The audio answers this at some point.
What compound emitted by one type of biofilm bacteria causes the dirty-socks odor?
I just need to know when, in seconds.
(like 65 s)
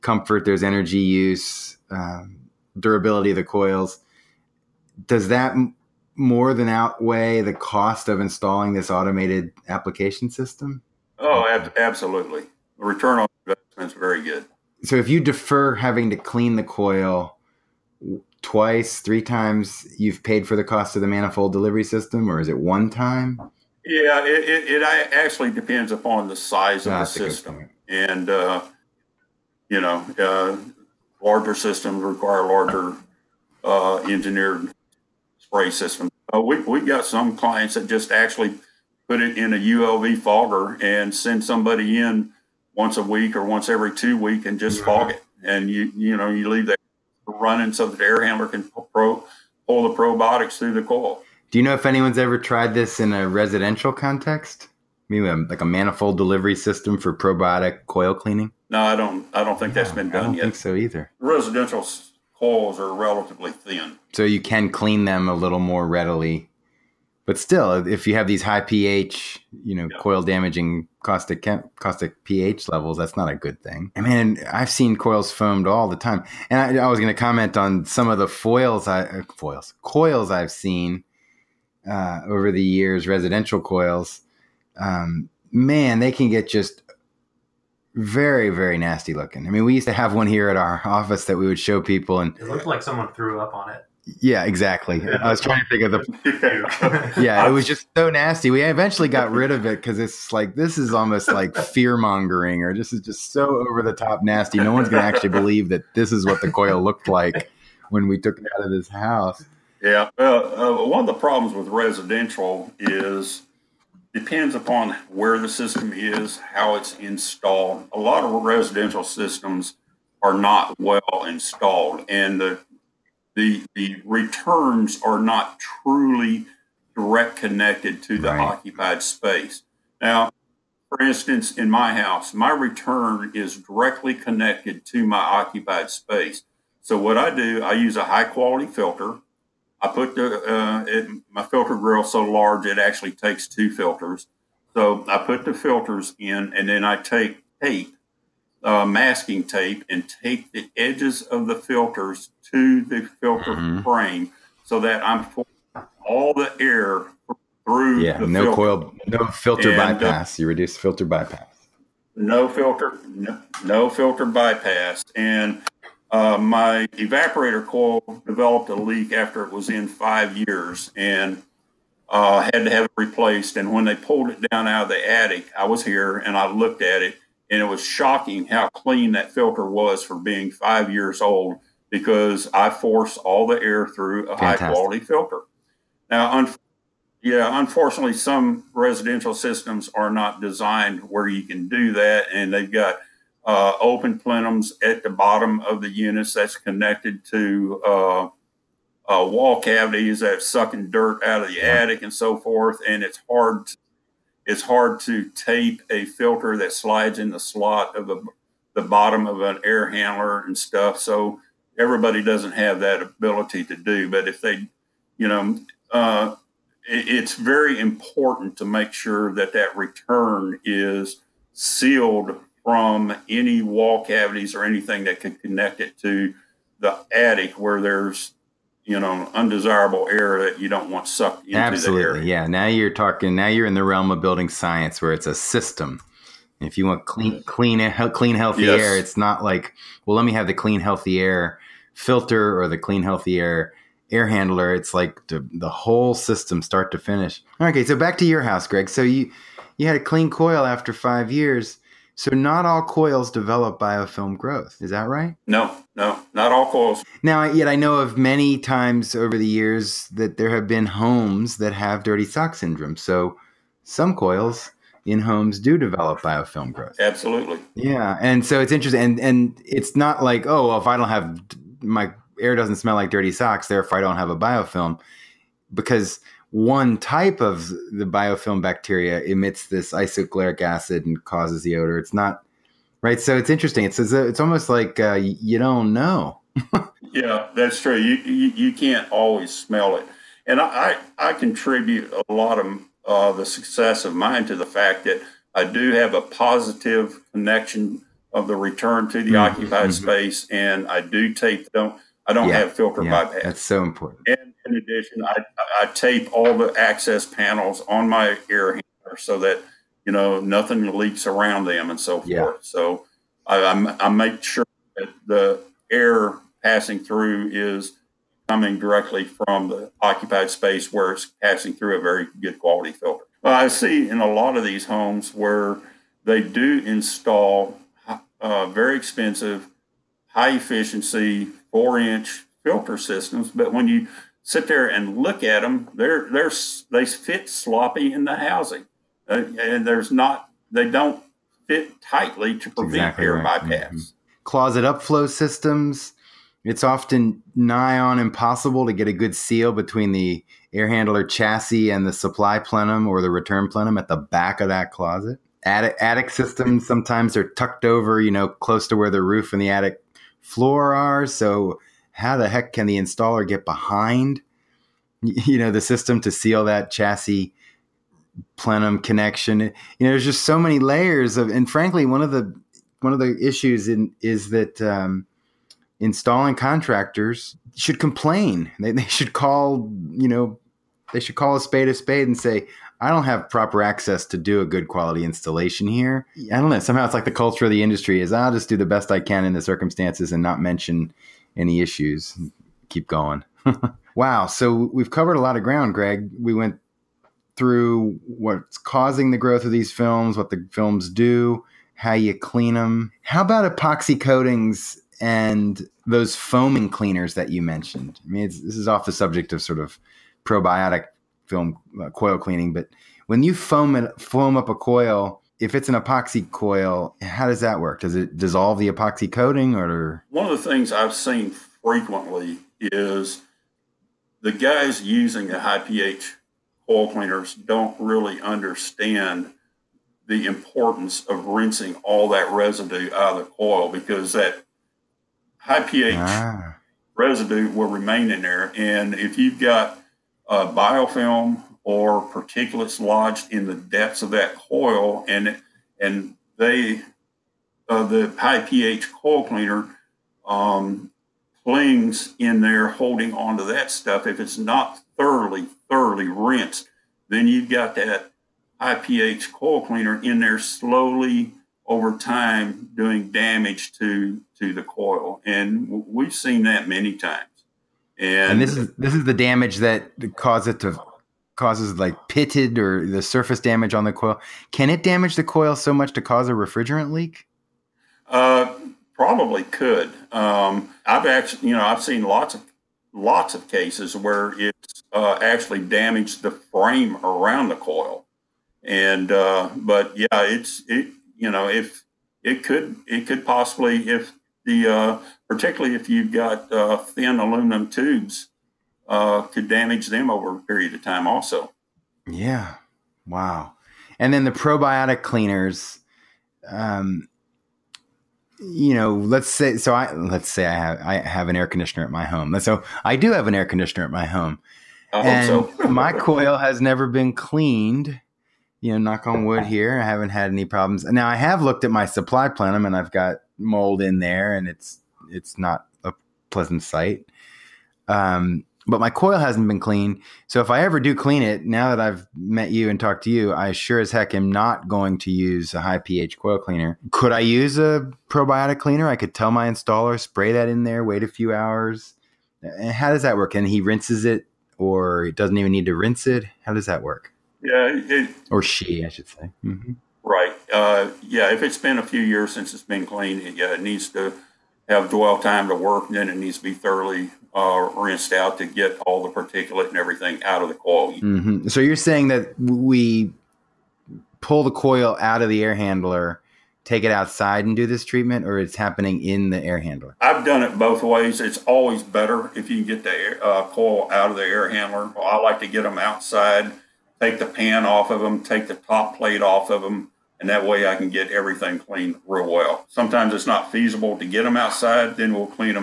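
279 s.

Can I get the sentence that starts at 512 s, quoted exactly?
So I do have an air conditioner at my home.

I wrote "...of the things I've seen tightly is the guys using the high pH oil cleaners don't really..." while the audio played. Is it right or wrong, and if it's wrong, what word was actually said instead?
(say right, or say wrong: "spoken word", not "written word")
wrong: "frequently", not "tightly".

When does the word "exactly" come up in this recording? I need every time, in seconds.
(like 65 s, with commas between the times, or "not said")
94 s, 342 s.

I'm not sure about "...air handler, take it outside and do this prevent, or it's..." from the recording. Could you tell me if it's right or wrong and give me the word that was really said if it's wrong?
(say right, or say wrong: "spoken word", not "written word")
wrong: "treatment", not "prevent".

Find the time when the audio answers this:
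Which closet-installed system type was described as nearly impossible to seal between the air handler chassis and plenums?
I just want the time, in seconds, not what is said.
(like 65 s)
344 s.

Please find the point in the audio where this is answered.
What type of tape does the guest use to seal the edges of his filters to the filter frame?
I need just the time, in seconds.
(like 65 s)
148 s.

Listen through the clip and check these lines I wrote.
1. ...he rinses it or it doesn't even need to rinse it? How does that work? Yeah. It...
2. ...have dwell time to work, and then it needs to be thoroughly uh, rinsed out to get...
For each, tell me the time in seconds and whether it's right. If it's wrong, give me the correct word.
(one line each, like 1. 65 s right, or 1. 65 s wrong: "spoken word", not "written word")
1. 543 s right
2. 554 s right.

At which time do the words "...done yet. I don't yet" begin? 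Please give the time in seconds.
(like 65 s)
60 s.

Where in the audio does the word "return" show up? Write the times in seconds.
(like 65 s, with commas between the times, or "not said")
12 s, 124 s, 132 s, 219 s, 298 s, 353 s.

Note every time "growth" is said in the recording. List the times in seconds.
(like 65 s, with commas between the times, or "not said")
254 s, 266 s, 399 s.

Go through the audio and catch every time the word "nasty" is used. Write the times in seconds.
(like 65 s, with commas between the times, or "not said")
88 s, 98 s, 104 s.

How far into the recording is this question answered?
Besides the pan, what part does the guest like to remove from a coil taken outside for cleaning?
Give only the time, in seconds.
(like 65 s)
578 s.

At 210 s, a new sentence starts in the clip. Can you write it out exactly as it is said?
So everybody doesn't have that ability to do.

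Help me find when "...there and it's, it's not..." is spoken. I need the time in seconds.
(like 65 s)
524 s.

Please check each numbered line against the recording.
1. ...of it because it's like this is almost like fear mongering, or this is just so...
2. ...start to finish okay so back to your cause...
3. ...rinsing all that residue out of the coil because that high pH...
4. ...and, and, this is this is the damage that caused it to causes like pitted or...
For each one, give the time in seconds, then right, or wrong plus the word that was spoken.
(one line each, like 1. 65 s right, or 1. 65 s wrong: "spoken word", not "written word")
1. 99 s right
2. 246 s wrong: "house", not "cause"
3. 431 s right
4. 468 s right.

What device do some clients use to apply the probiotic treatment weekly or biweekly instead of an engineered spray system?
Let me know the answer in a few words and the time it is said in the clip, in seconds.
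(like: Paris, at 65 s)
ULV fogger, at 39 s.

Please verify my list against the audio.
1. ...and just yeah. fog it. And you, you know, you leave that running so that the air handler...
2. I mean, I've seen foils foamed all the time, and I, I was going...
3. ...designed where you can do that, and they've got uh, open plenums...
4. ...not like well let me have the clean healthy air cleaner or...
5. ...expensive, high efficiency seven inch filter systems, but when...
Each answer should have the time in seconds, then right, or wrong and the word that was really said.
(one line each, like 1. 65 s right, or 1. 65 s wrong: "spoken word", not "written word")
1. 44 s right
2. 73 s wrong: "coils", not "foils"
3. 190 s right
4. 239 s wrong: "filter", not "cleaner"
5. 328 s wrong: "four", not "seven".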